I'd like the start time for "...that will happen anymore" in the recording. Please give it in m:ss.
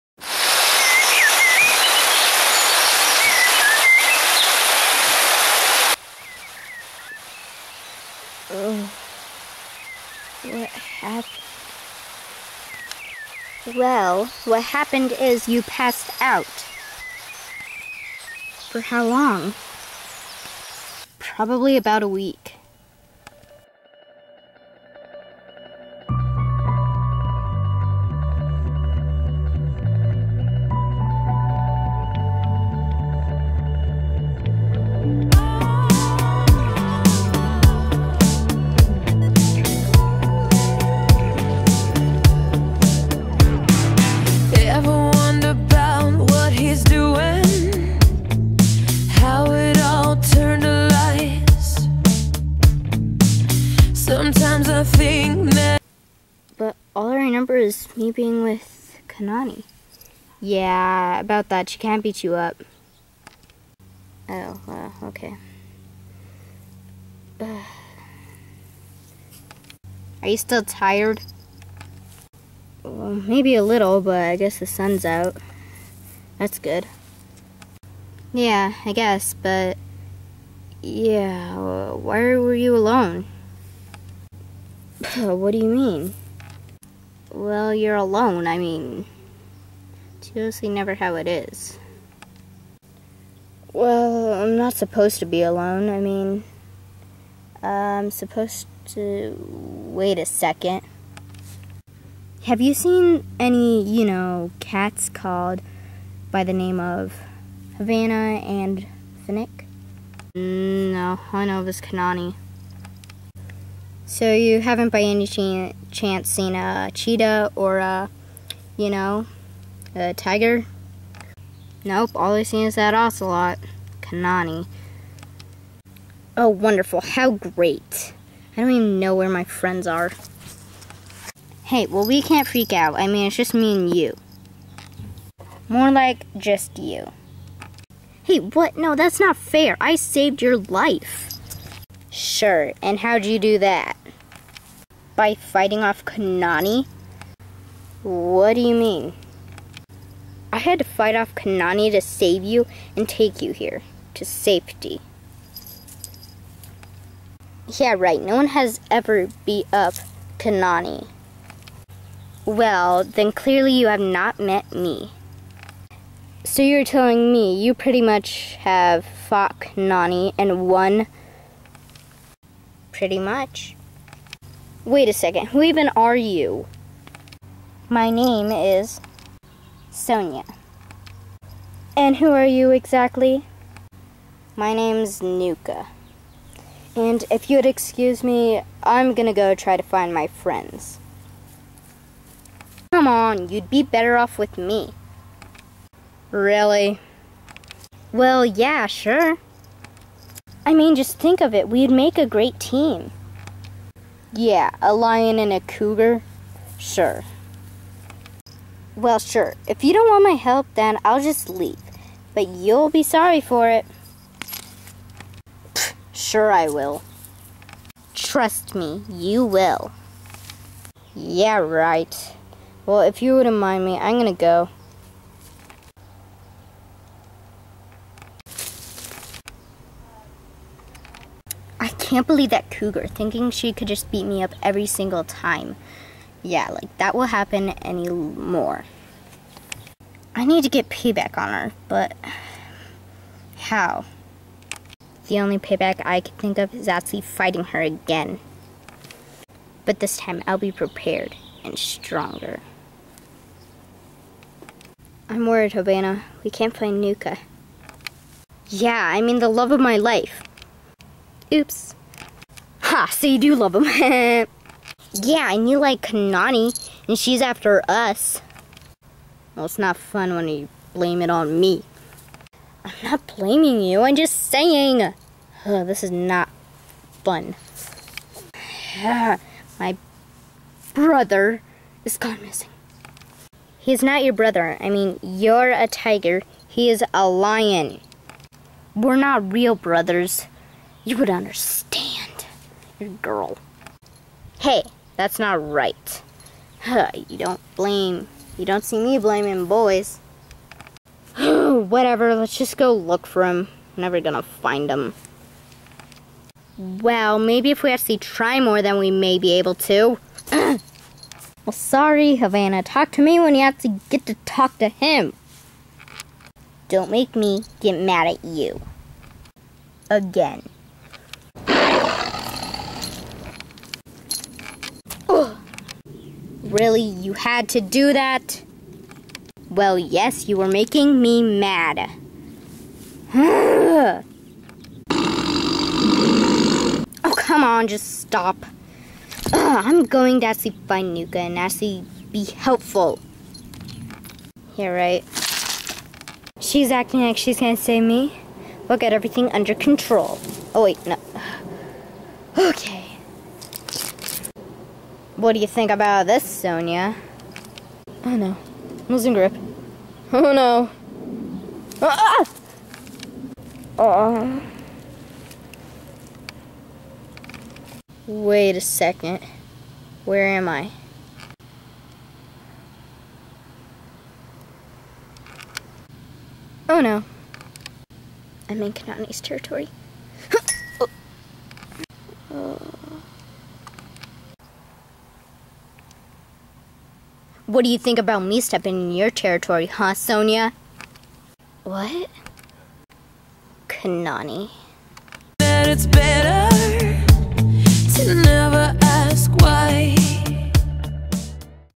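3:56.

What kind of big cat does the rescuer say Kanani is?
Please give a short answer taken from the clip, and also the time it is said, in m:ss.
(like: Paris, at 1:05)
Ocelot, at 2:02.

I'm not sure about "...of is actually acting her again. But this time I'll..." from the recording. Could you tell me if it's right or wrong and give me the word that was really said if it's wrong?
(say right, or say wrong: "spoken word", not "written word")
wrong: "fighting", not "acting".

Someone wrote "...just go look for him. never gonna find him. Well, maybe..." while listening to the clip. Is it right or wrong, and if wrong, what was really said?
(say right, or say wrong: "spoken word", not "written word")
right.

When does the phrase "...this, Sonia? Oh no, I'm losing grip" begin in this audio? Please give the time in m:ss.
5:56.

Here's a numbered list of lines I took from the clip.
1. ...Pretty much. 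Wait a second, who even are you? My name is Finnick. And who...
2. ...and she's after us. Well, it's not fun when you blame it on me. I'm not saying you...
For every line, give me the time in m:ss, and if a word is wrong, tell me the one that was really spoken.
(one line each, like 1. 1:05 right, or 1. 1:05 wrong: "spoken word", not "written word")
1. 2:52 wrong: "Sonia", not "Finnick"
2. 4:27 wrong: "blaming", not "saying".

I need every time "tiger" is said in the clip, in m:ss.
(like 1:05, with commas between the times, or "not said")
2:00, 4:45.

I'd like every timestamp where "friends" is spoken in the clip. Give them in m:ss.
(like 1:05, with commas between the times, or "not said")
2:09, 3:10.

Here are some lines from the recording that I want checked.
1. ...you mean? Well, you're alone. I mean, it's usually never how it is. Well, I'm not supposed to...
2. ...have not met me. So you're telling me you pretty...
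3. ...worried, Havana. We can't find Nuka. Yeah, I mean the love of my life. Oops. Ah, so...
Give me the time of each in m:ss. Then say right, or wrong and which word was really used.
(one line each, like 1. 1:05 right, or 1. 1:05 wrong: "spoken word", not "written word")
1. 1:25 right
2. 2:43 right
3. 4:15 right.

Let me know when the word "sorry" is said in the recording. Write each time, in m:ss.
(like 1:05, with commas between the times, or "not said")
3:33, 5:11.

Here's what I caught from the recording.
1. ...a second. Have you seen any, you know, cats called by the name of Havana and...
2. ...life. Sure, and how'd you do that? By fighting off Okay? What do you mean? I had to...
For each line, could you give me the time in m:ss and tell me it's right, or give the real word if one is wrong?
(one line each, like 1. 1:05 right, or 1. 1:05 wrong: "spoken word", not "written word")
1. 1:40 right
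2. 2:20 wrong: "Kanani", not "Okay".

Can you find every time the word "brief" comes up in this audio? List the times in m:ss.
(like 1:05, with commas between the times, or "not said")
not said.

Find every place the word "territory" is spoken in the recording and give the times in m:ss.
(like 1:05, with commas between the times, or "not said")
6:19, 6:29.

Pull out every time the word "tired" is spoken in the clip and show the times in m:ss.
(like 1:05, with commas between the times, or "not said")
1:10.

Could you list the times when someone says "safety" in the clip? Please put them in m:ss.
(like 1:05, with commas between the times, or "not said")
2:34.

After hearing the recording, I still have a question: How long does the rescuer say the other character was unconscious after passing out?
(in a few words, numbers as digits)
About a week.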